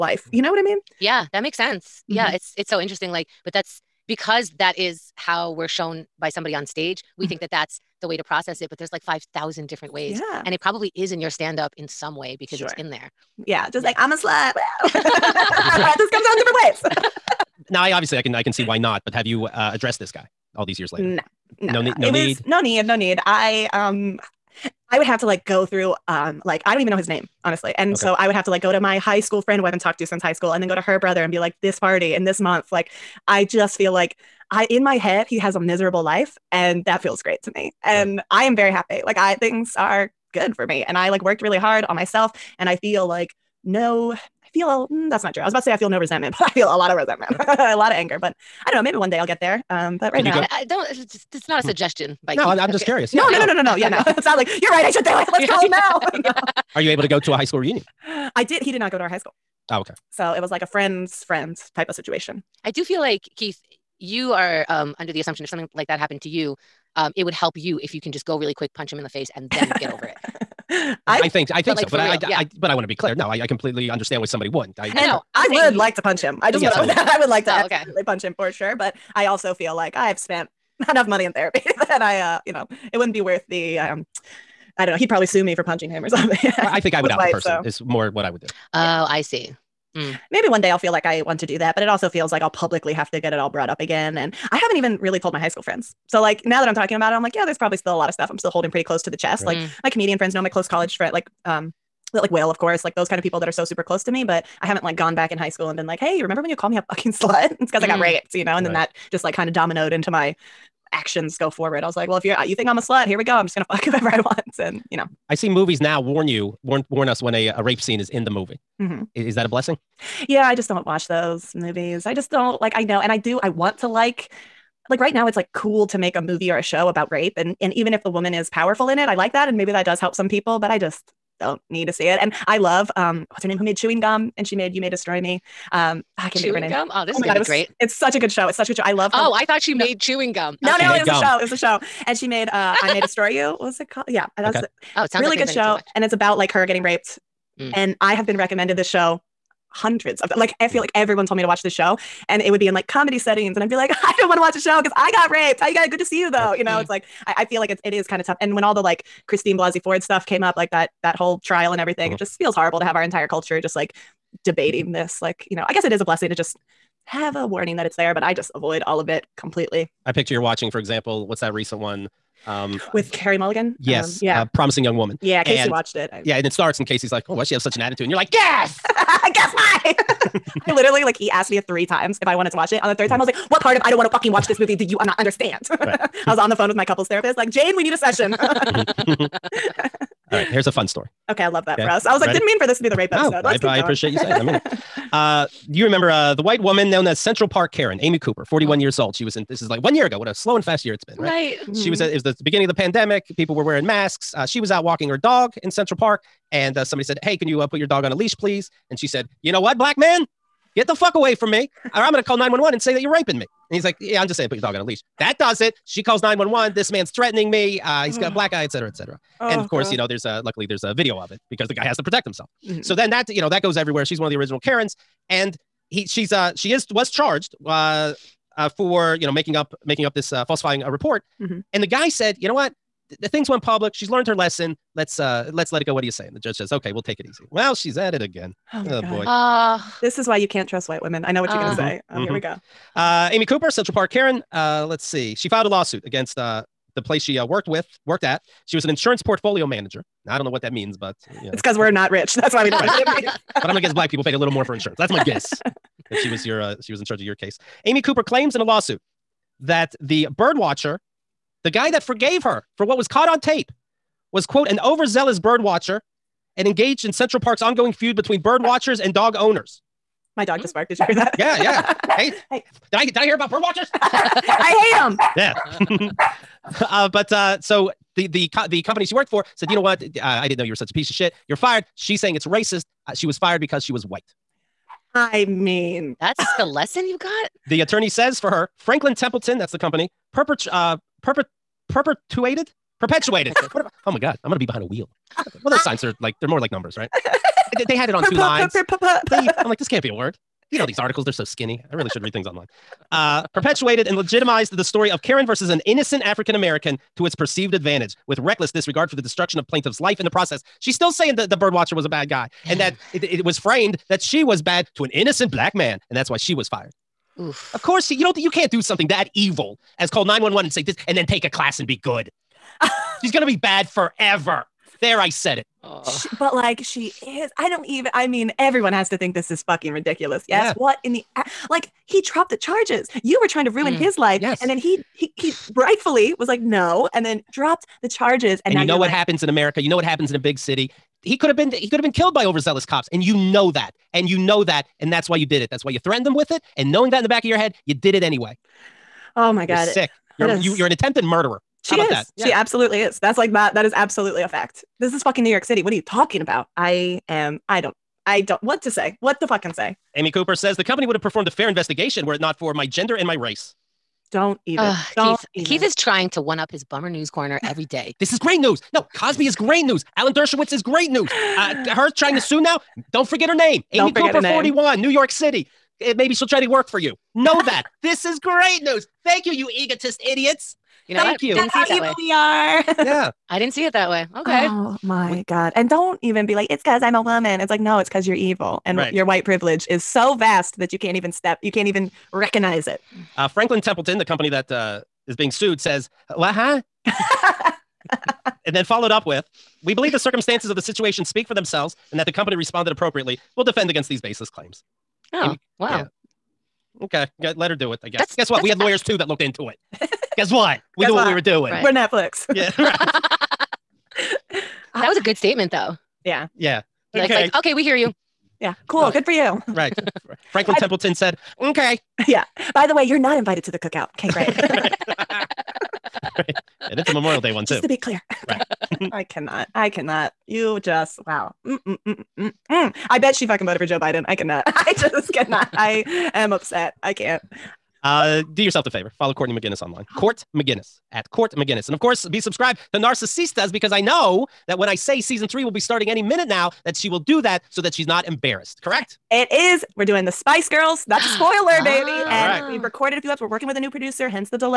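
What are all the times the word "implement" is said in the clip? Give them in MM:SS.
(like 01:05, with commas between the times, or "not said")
not said.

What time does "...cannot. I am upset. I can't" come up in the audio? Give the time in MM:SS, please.
07:15.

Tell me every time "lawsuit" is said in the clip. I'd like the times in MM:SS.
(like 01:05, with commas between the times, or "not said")
04:05, 04:18.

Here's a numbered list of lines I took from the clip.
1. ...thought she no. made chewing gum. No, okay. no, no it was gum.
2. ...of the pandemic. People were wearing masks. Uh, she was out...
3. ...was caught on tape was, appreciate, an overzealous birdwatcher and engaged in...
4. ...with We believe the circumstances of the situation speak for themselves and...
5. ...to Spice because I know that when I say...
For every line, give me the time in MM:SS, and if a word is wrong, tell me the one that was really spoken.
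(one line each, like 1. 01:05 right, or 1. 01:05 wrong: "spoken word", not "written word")
1. 02:19 right
2. 03:22 right
3. 04:22 wrong: "quote", not "appreciate"
4. 06:39 right
5. 07:22 wrong: "Narcissistas", not "Spice".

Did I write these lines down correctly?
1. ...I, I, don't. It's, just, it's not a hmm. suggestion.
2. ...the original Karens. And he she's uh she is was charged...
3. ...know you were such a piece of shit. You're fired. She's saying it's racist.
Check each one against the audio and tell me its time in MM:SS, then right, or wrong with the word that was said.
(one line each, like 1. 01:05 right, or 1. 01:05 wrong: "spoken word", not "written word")
1. 00:50 right
2. 03:44 right
3. 04:40 right.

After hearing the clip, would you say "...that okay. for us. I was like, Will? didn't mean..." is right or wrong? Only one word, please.
wrong.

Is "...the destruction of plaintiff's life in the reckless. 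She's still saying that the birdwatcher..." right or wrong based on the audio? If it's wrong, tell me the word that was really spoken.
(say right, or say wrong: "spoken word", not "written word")
wrong: "process", not "reckless".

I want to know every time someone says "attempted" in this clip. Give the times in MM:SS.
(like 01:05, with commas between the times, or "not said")
05:50.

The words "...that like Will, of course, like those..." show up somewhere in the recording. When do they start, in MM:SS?
01:42.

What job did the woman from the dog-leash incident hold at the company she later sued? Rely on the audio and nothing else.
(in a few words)
insurance portfolio manager.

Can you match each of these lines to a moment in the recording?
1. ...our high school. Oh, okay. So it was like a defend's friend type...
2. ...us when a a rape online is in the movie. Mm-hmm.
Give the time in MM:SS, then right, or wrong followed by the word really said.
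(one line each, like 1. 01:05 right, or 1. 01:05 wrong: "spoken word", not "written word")
1. 00:59 wrong: "friend", not "defend"
2. 01:57 wrong: "scene", not "online".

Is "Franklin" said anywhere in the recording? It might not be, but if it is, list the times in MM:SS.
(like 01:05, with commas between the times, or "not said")
04:48, 06:33, 07:00.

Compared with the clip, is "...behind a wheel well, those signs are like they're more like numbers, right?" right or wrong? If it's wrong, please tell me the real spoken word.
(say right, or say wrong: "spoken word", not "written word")
right.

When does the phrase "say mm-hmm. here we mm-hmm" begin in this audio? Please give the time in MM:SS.
04:01.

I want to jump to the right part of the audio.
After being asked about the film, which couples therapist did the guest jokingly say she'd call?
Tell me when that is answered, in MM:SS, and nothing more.
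03:07.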